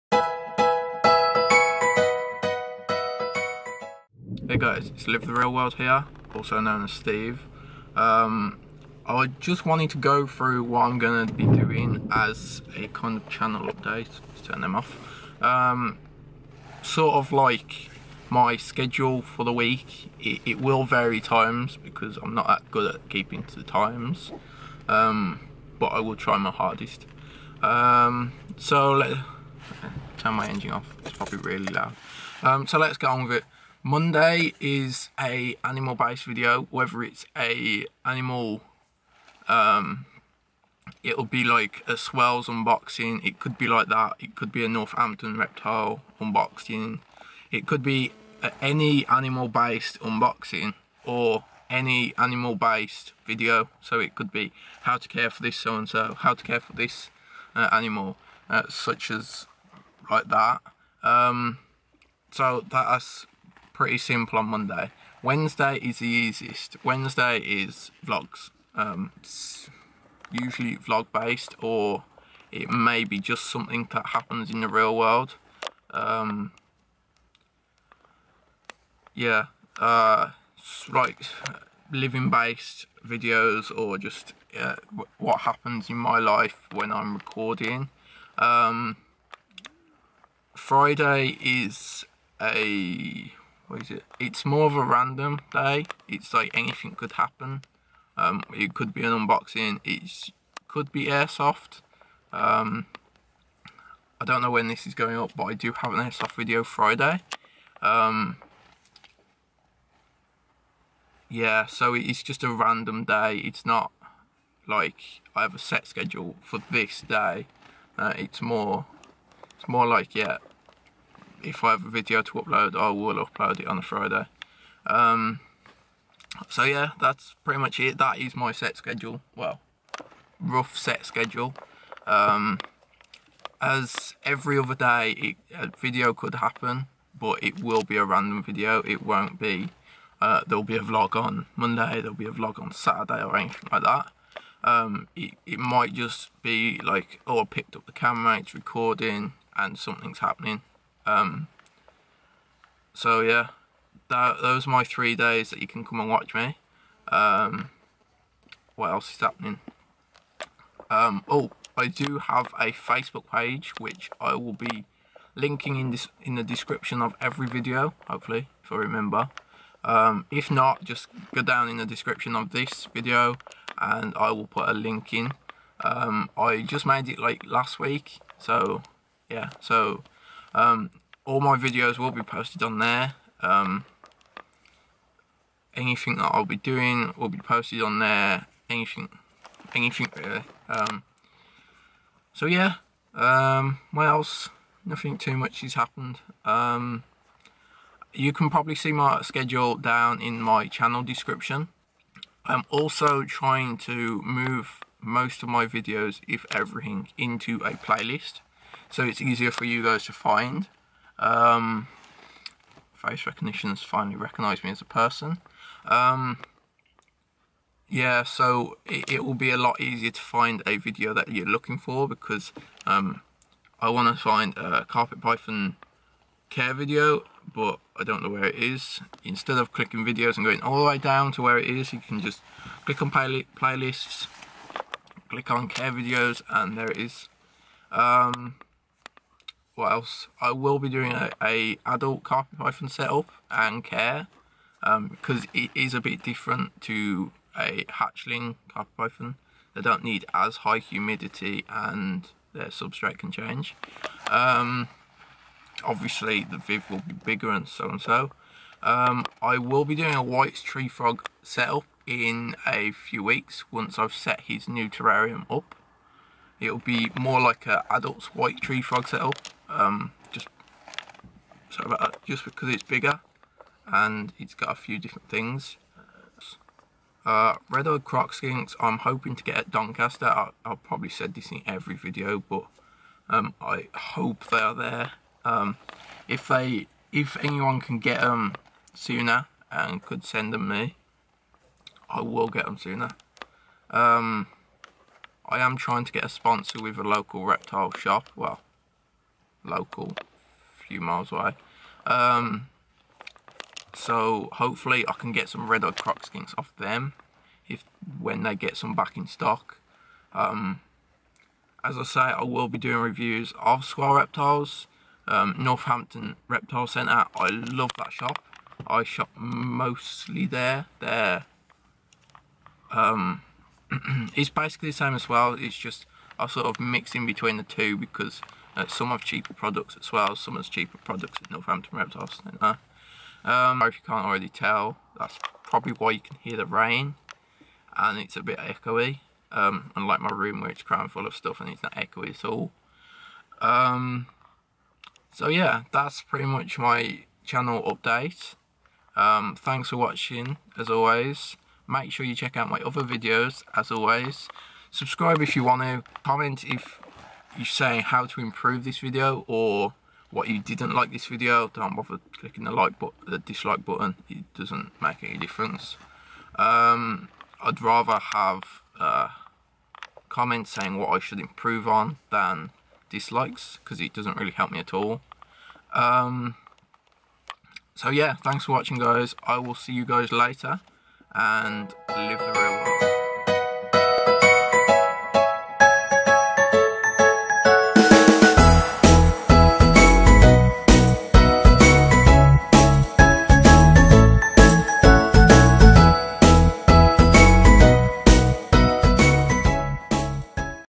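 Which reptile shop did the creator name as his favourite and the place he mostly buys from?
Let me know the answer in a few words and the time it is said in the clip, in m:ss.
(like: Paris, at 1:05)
Northampton Reptile Centre, at 5:15.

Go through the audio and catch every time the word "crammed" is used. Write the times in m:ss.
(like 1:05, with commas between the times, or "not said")
5:40.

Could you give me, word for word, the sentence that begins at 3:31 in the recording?
Um, face has finally recognised me as a person.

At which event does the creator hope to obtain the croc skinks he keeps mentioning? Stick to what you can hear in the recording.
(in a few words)
Doncaster.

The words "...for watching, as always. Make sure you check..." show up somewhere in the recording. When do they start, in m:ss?
5:49.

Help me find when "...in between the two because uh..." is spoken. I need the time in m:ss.
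5:27.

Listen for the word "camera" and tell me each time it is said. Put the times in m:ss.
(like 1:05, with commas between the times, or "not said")
2:27.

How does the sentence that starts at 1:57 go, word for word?
Uh, it's more, it's more like yeah, if I have a video to upload, I will upload it on a Friday.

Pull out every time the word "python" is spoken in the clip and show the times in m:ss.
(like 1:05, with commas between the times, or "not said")
3:45, 4:02, 4:08.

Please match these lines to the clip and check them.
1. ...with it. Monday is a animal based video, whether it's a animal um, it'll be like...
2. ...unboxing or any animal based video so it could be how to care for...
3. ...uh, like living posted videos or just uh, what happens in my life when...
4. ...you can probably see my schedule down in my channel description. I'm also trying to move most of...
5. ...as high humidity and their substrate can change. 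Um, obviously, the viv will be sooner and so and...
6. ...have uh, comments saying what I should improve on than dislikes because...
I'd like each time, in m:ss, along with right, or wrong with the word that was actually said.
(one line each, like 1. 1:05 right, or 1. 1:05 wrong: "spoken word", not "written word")
1. 0:33 right
2. 0:50 right
3. 1:19 wrong: "based", not "posted"
4. 3:18 right
5. 4:10 wrong: "bigger", not "sooner"
6. 6:08 right.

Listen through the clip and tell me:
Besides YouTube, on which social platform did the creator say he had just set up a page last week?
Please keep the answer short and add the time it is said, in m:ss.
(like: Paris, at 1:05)
Facebook, at 2:42.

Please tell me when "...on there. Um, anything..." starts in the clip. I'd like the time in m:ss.
3:02.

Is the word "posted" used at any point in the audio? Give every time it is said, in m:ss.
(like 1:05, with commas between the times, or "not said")
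3:02, 3:07.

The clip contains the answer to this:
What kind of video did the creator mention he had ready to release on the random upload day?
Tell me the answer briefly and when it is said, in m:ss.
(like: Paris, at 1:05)
airsoft video, at 1:45.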